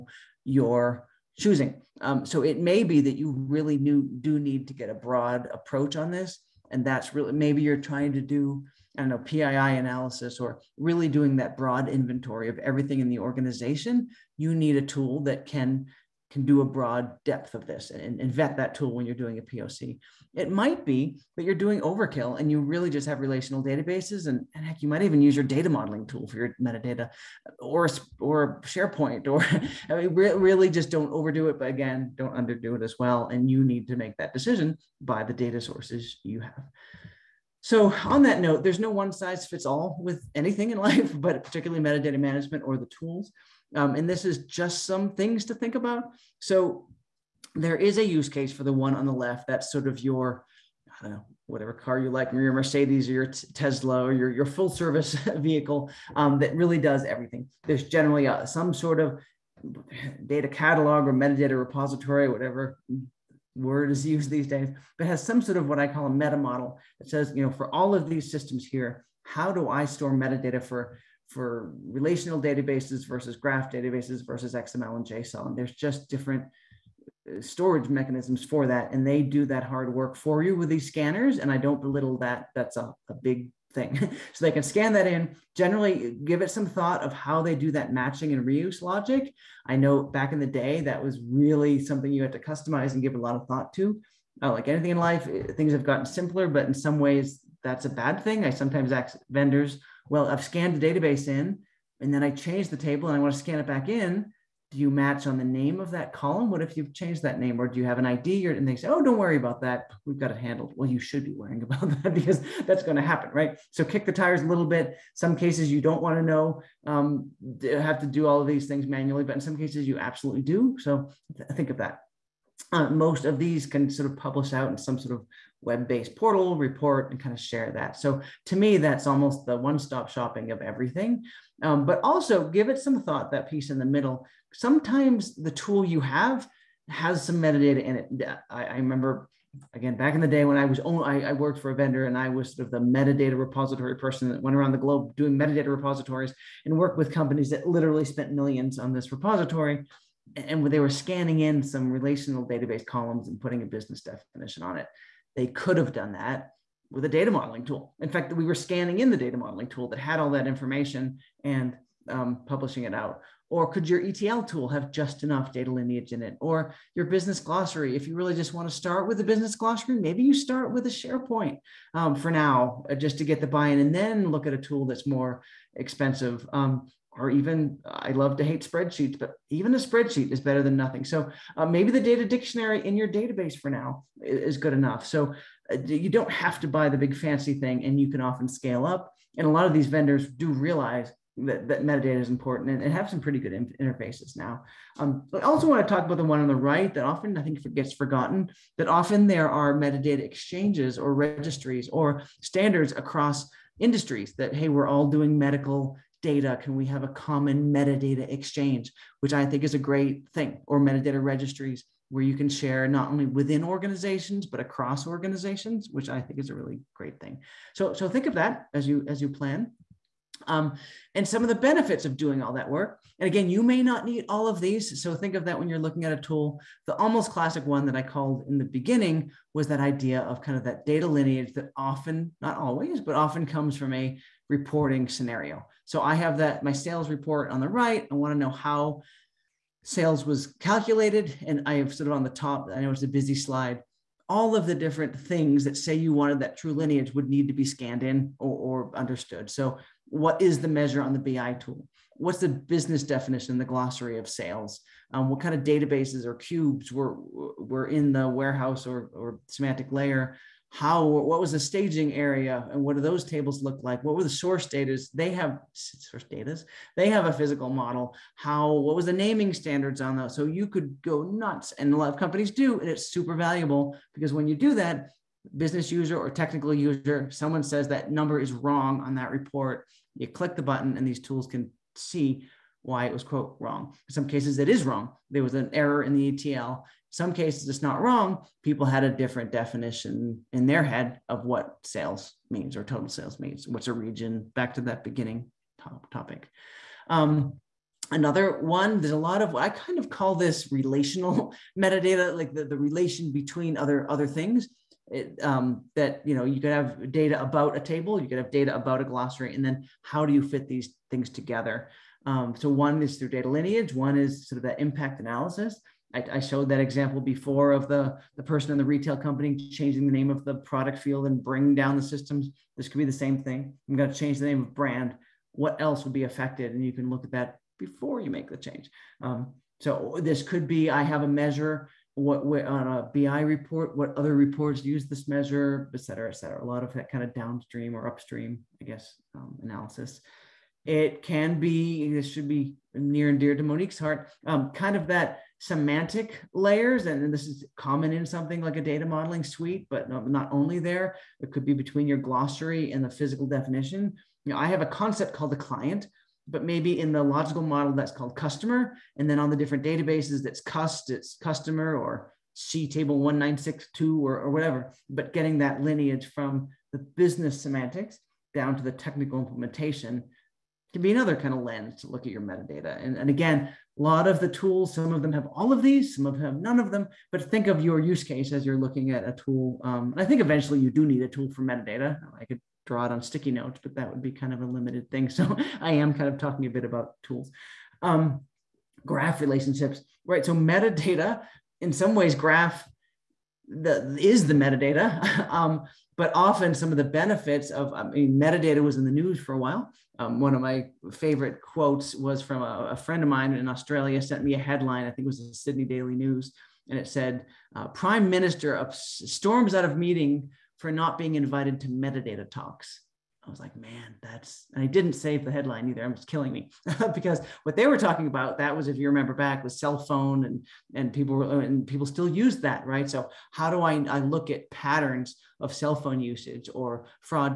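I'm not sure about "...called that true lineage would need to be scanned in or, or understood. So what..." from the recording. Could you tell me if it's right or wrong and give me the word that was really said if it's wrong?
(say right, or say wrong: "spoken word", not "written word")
wrong: "wanted", not "called".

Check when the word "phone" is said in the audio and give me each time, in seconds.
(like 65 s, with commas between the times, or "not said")
419 s, 425 s.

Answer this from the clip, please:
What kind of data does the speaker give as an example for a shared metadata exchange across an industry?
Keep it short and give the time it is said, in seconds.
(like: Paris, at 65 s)
medical data, at 205 s.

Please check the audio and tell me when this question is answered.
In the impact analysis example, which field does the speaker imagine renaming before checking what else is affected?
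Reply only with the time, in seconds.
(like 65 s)
324 s.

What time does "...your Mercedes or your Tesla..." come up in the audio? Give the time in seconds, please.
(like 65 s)
52 s.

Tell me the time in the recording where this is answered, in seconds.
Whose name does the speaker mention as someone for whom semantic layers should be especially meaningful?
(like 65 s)
343 s.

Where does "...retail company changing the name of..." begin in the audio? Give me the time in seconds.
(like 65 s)
318 s.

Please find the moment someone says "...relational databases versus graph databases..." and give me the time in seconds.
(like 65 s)
71 s.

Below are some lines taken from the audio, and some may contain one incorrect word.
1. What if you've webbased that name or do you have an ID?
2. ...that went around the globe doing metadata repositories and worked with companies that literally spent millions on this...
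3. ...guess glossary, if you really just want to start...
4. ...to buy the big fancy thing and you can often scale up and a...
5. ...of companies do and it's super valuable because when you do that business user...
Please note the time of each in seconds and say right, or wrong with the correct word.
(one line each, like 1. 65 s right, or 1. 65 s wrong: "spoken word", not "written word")
1. 106 s wrong: "changed", not "webbased"
2. 144 s right
3. 167 s wrong: "business", not "guess"
4. 186 s right
5. 272 s right.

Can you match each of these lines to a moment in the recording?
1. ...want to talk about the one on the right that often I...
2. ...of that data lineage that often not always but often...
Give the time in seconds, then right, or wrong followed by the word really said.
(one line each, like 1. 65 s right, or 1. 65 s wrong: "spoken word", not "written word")
1. 195 s right
2. 230 s right.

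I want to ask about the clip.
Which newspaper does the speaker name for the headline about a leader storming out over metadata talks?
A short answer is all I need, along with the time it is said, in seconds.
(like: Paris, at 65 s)
Sydney Daily News, at 405 s.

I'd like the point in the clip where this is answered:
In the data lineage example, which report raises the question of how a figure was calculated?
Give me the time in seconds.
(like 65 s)
236 s.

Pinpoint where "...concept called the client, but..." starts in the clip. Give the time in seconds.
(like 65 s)
354 s.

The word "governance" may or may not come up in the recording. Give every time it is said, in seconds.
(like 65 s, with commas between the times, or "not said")
not said.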